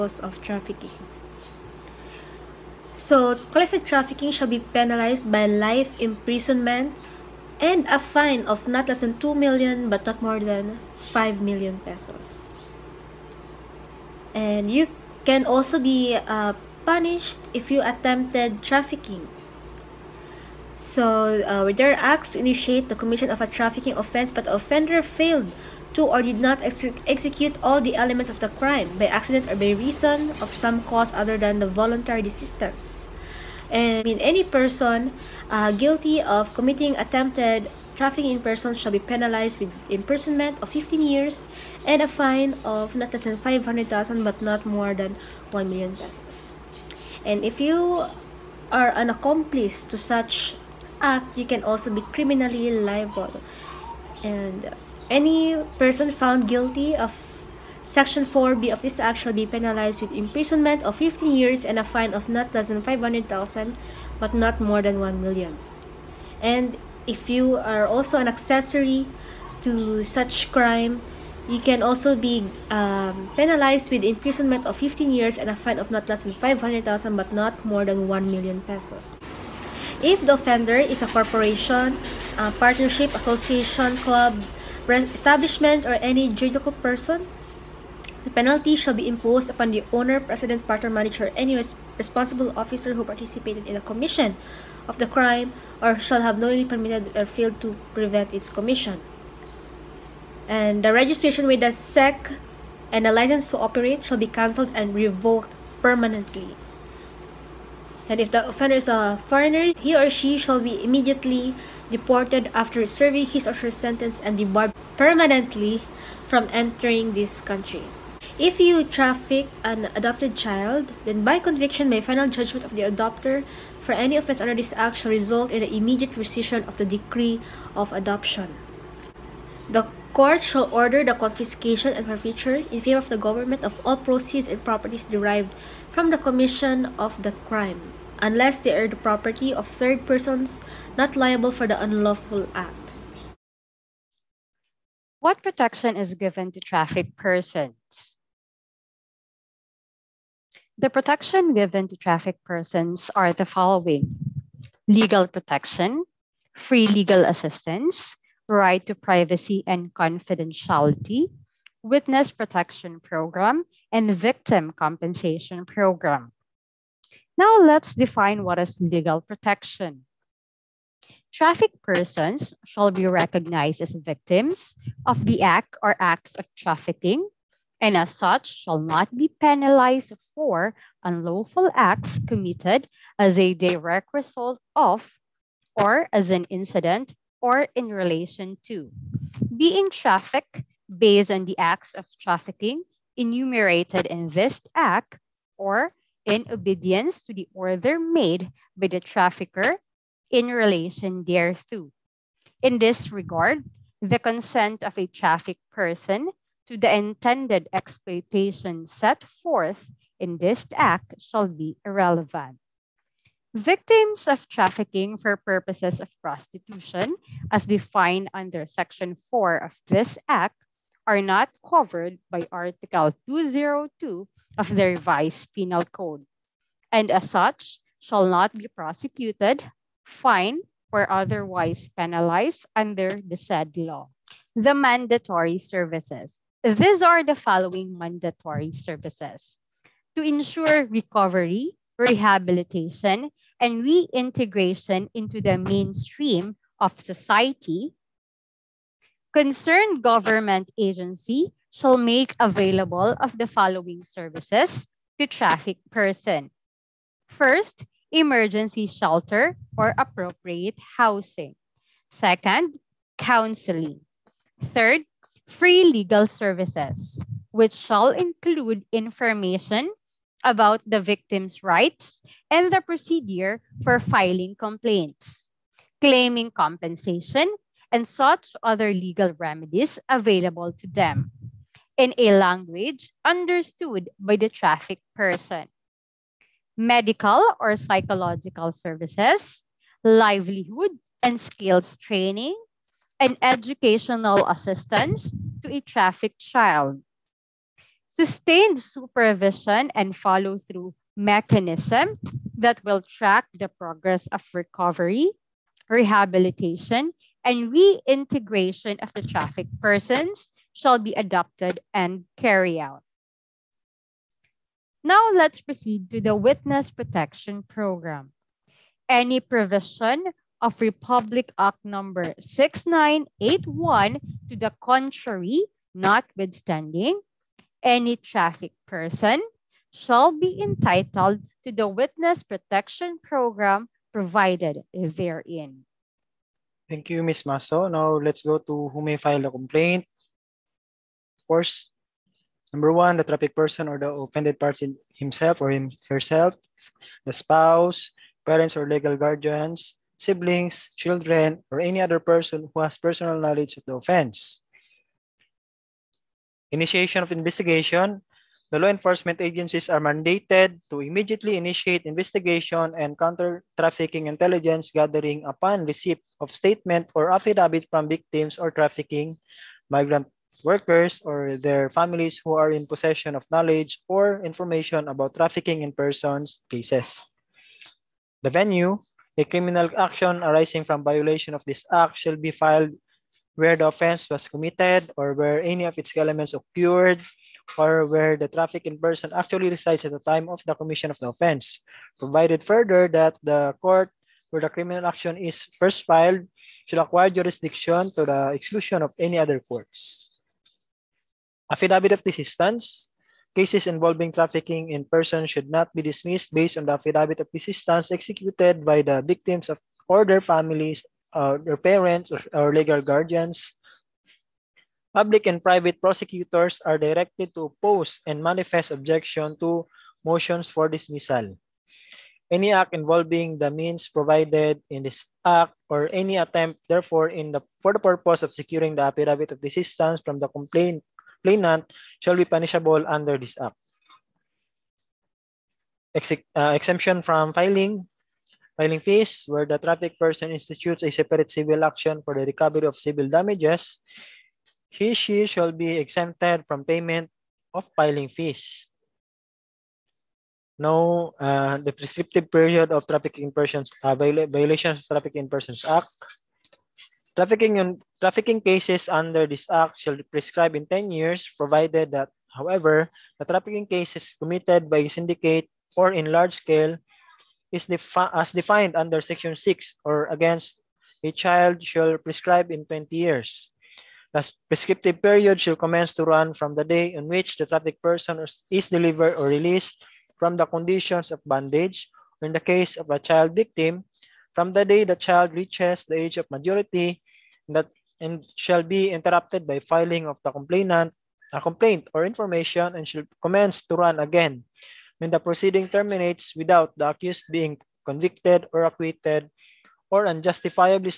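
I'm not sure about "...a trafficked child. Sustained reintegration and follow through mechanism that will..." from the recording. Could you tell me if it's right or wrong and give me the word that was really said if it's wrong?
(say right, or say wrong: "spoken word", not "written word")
wrong: "supervision", not "reintegration".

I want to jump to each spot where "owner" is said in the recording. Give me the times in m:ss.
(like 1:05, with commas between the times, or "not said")
1:29.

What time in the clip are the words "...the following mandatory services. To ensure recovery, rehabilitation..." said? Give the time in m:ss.
3:57.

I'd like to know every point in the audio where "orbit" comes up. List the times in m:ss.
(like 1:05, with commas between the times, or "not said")
not said.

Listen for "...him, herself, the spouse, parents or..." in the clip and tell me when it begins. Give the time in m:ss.
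5:45.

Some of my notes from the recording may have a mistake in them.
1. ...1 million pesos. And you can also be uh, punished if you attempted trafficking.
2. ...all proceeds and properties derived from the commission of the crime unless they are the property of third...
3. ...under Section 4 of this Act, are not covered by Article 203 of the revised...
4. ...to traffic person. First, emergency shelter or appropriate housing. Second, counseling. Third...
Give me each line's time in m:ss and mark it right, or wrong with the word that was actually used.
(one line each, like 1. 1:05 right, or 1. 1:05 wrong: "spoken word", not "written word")
1. 0:11 wrong: "5", not "1"
2. 2:13 right
3. 3:38 wrong: "202", not "203"
4. 4:15 right.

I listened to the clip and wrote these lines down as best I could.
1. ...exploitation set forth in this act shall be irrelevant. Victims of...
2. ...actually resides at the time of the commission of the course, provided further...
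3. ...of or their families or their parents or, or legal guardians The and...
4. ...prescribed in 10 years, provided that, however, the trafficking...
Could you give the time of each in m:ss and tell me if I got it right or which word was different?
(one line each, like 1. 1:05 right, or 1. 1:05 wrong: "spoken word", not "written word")
1. 3:27 right
2. 6:29 wrong: "offense", not "course"
3. 6:49 wrong: "Public", not "The"
4. 7:40 right.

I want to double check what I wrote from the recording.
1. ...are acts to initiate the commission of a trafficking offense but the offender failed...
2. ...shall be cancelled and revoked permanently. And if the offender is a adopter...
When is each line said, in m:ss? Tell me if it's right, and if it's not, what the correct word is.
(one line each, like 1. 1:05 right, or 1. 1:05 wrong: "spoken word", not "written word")
1. 0:21 right
2. 1:44 wrong: "foreigner", not "adopter".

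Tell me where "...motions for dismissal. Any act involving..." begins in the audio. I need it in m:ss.
7:00.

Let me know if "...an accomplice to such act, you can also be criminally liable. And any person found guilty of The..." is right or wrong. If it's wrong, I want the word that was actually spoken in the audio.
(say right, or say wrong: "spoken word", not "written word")
wrong: "Section", not "The".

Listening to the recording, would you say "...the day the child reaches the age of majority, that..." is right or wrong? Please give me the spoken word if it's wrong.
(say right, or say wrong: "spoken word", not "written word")
right.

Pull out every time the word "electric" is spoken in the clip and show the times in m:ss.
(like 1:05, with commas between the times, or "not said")
not said.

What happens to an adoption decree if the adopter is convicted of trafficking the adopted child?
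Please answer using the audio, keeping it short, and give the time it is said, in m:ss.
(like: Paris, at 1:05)
immediate rescission, at 2:05.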